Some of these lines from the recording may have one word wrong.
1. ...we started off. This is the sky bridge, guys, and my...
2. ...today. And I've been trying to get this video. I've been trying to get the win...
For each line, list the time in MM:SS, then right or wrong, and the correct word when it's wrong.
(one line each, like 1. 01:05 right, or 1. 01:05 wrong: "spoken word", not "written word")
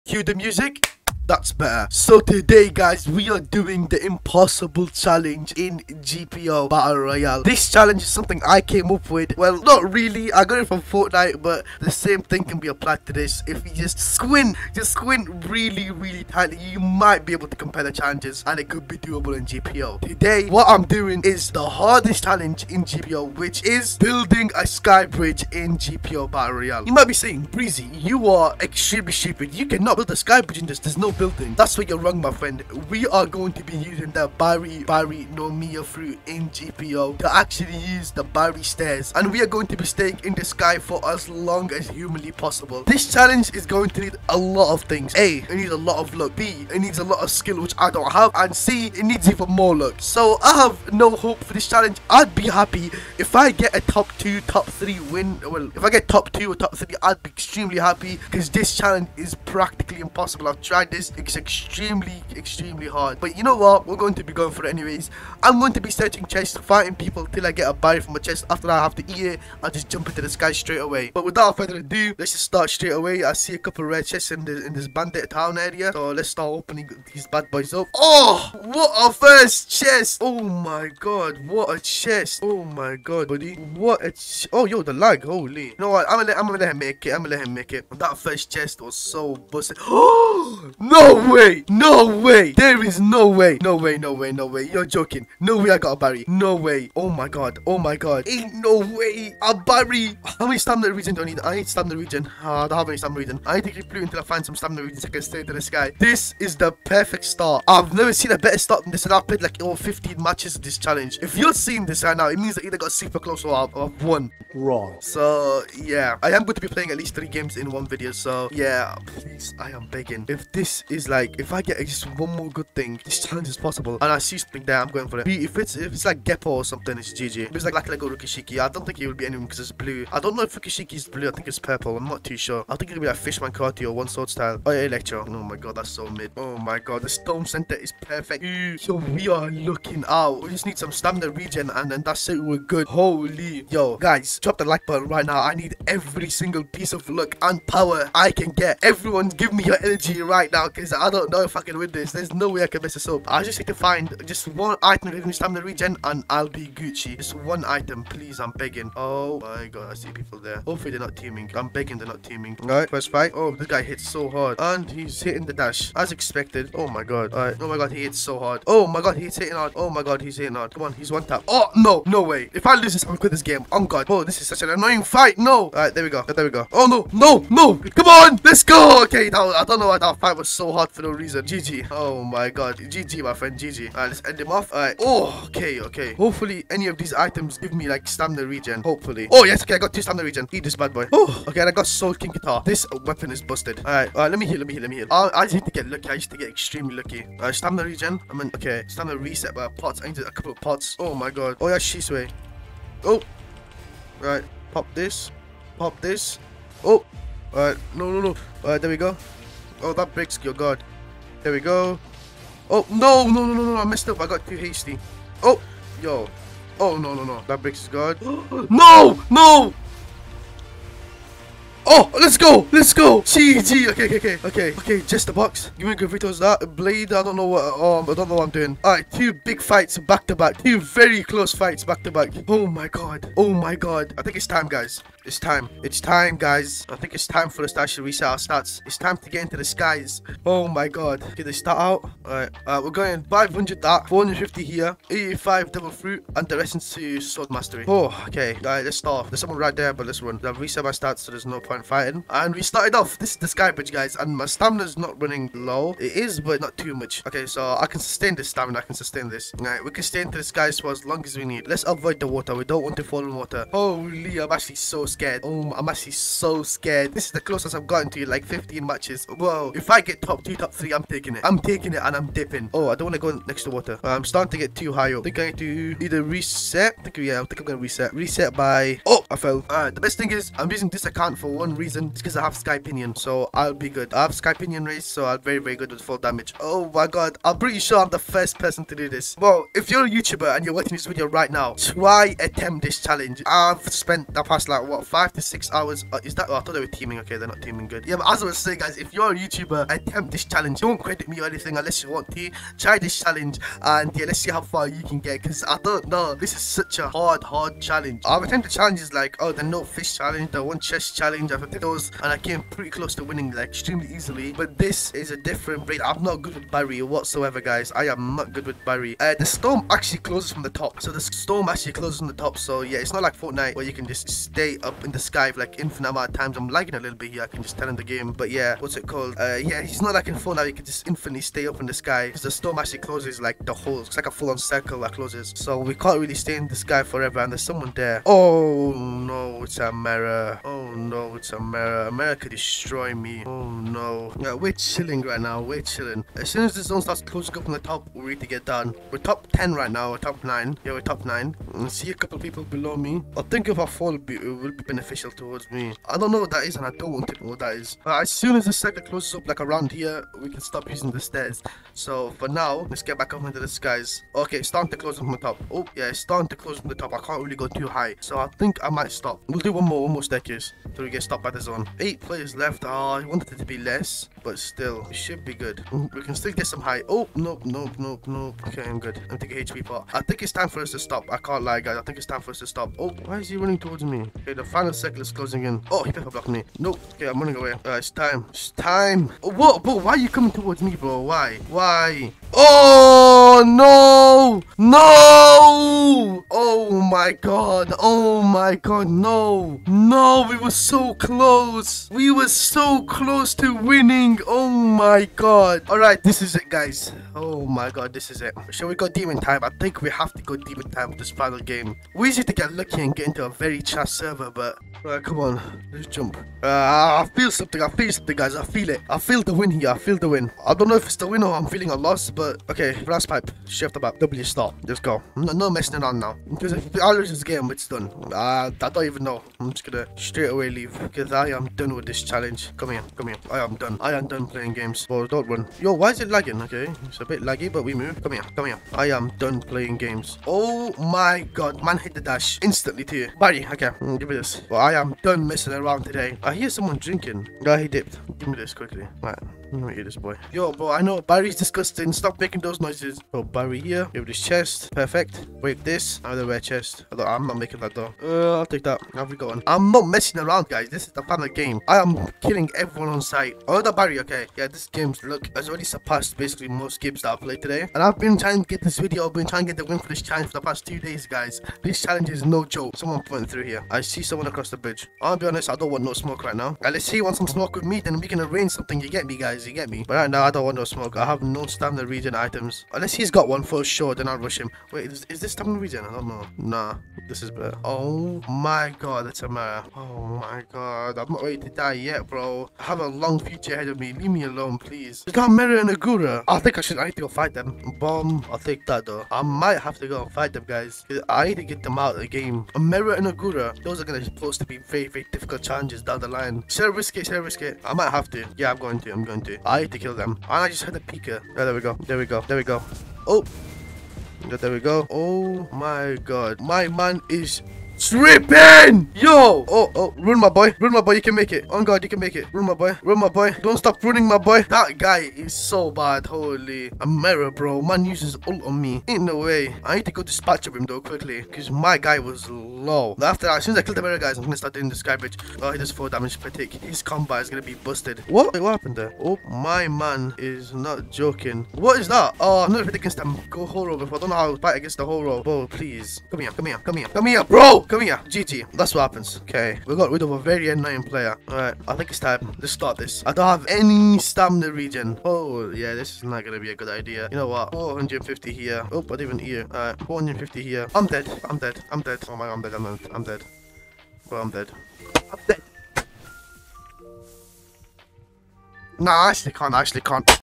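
1. 04:12 right
2. 07:47 right.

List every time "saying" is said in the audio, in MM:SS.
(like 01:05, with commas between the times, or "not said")
00:27, 04:58.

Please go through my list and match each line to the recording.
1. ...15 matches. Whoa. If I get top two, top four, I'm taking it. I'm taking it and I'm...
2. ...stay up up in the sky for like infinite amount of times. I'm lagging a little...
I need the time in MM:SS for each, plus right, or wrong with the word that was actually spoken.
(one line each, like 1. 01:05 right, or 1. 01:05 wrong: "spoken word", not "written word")
1. 04:28 wrong: "three", not "four"
2. 05:24 right.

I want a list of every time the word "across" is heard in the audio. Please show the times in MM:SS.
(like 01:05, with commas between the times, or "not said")
07:54.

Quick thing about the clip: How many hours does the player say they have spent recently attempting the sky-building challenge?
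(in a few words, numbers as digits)
five to six hours.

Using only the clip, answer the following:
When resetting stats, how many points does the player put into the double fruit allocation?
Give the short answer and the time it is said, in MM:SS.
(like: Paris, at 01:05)
85, at 04:05.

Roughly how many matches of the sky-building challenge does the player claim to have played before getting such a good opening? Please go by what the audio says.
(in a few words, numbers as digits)
15.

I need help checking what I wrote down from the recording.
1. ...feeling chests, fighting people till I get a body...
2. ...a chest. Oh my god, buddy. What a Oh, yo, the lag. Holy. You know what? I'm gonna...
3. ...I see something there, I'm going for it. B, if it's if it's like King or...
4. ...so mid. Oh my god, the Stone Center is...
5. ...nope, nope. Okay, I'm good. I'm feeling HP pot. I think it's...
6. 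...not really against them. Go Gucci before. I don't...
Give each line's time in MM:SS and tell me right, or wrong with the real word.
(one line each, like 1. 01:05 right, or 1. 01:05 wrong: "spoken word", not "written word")
1. 01:05 wrong: "searching", not "feeling"
2. 01:21 right
3. 02:04 wrong: "Geppo", not "King"
4. 02:15 right
5. 06:17 wrong: "taking", not "feeling"
6. 09:02 wrong: "Horo", not "Gucci".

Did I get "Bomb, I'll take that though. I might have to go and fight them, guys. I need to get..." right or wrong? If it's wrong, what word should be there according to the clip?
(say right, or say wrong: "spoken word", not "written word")
right.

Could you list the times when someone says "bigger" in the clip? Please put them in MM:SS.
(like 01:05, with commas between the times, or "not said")
not said.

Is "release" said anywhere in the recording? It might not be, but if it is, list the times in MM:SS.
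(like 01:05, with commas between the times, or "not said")
not said.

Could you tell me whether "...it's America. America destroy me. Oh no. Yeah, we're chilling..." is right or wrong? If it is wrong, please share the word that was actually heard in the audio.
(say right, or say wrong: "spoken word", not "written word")
right.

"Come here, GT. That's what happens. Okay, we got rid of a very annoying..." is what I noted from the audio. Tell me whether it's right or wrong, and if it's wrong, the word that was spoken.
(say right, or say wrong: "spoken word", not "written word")
right.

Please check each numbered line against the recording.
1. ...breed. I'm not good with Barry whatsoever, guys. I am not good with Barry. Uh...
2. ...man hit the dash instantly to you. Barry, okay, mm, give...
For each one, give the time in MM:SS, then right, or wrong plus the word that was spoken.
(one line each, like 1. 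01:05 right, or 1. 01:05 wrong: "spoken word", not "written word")
1. 05:15 right
2. 07:21 right.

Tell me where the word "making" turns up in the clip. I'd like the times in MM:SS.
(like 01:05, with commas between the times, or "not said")
07:32, 07:37.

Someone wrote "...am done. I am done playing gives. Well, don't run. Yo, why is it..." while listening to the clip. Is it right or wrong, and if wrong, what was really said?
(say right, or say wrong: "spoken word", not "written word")
wrong: "games", not "gives".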